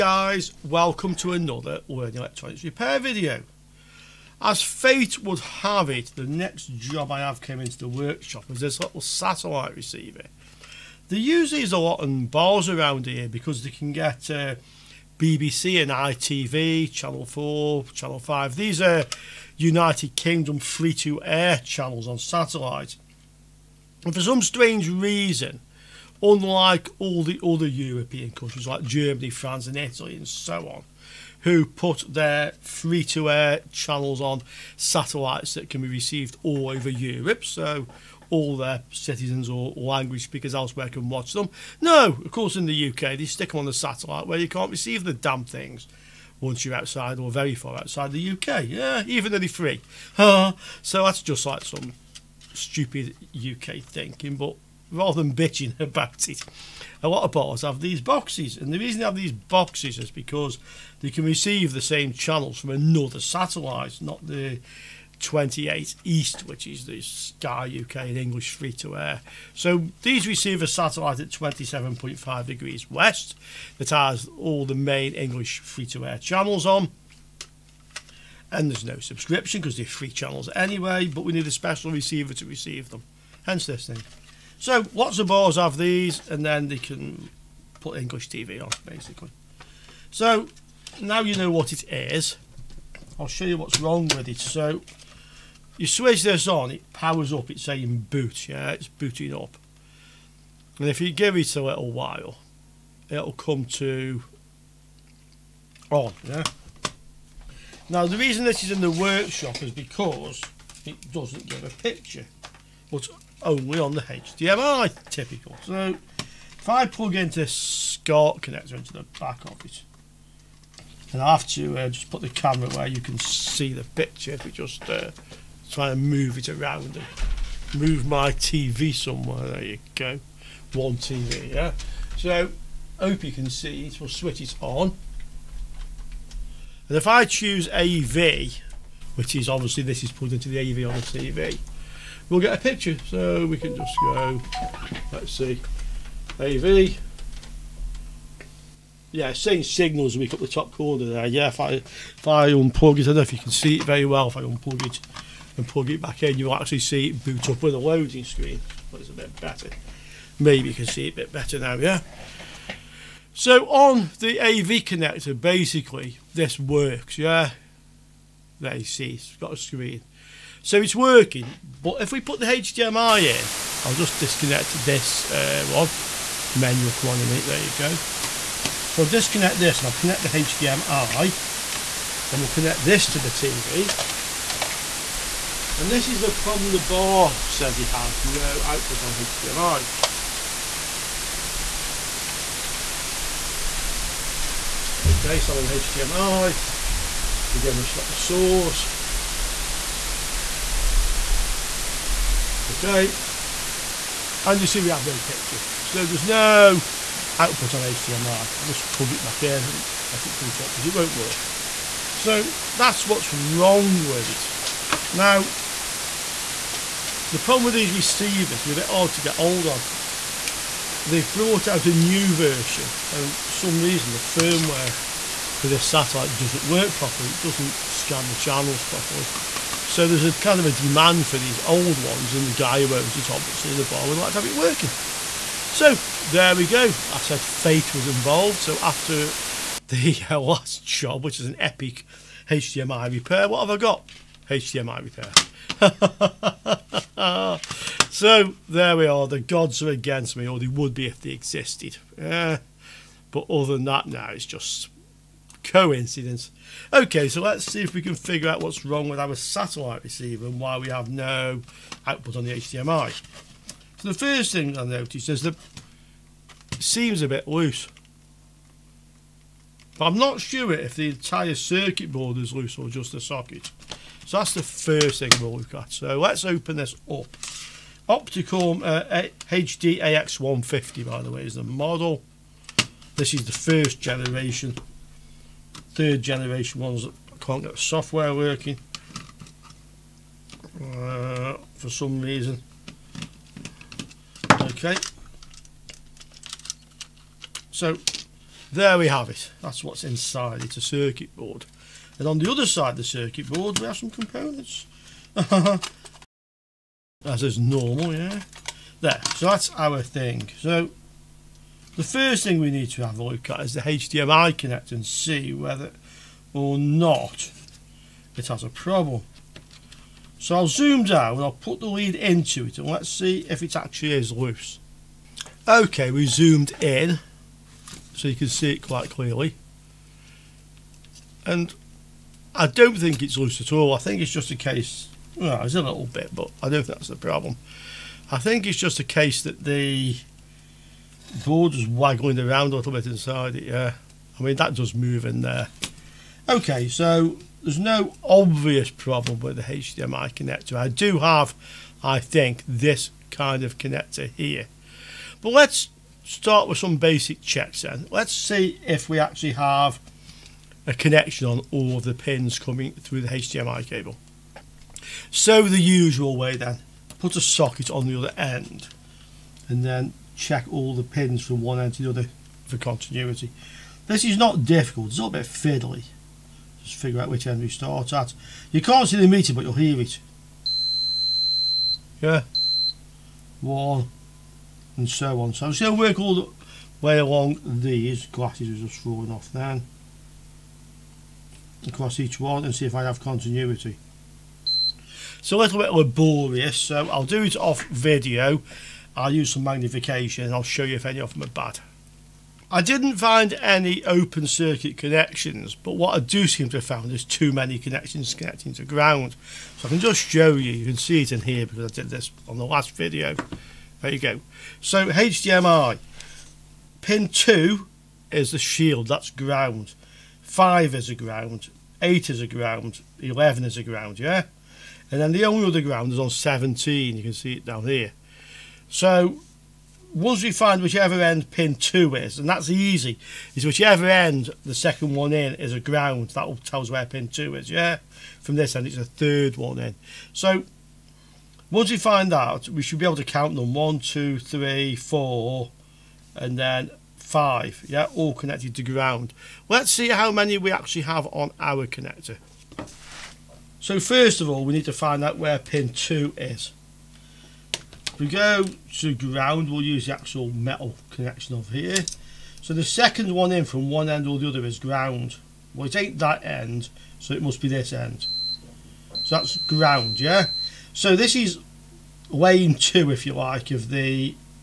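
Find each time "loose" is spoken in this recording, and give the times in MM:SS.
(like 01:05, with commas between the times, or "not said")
04:27, 04:32, 05:24, 05:33.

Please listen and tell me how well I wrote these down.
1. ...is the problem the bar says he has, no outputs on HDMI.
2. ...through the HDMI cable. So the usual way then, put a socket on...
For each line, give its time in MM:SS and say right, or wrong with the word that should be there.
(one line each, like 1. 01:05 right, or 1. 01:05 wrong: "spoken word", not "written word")
1. 03:06 right
2. 06:02 right.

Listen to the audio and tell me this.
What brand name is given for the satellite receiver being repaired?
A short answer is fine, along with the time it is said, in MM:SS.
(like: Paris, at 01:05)
Opticum, at 04:38.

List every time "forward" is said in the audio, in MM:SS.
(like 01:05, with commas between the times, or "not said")
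not said.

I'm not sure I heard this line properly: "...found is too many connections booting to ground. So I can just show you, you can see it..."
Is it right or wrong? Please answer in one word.
wrong.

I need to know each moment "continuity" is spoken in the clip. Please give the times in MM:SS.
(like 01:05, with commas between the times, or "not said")
06:12, 06:33.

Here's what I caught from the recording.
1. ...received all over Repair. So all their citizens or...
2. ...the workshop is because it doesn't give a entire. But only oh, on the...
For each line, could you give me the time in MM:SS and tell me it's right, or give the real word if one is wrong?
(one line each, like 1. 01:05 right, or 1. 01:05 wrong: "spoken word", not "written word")
1. 00:35 wrong: "Europe", not "Repair"
2. 01:48 wrong: "picture", not "entire".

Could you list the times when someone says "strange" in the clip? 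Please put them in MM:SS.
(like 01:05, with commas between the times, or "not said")
00:24.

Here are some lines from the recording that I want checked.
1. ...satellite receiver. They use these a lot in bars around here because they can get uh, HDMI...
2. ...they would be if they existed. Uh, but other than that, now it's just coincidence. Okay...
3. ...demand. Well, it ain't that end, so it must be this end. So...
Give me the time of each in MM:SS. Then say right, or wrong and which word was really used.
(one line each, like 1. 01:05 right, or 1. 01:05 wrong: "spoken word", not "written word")
1. 00:09 wrong: "BBC", not "HDMI"
2. 04:10 right
3. 07:44 wrong: "ground", not "demand".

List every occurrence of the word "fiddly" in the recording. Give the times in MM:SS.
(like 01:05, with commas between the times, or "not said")
06:15.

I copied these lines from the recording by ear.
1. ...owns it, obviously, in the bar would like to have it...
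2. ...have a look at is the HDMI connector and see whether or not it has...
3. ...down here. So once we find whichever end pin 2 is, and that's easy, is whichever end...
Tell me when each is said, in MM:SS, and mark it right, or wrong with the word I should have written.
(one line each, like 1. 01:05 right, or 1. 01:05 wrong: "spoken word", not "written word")
1. 03:52 right
2. 05:13 right
3. 07:07 right.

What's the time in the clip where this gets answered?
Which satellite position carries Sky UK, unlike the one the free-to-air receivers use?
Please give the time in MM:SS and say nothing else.
01:05.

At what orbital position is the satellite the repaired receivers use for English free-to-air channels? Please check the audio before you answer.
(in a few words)
27.5 degrees west.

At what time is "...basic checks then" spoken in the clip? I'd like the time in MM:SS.
05:56.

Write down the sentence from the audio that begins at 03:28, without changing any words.
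I'll just plug it back in and let it boot up because it won't work.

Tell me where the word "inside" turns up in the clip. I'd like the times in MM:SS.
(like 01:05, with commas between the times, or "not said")
05:00, 05:43.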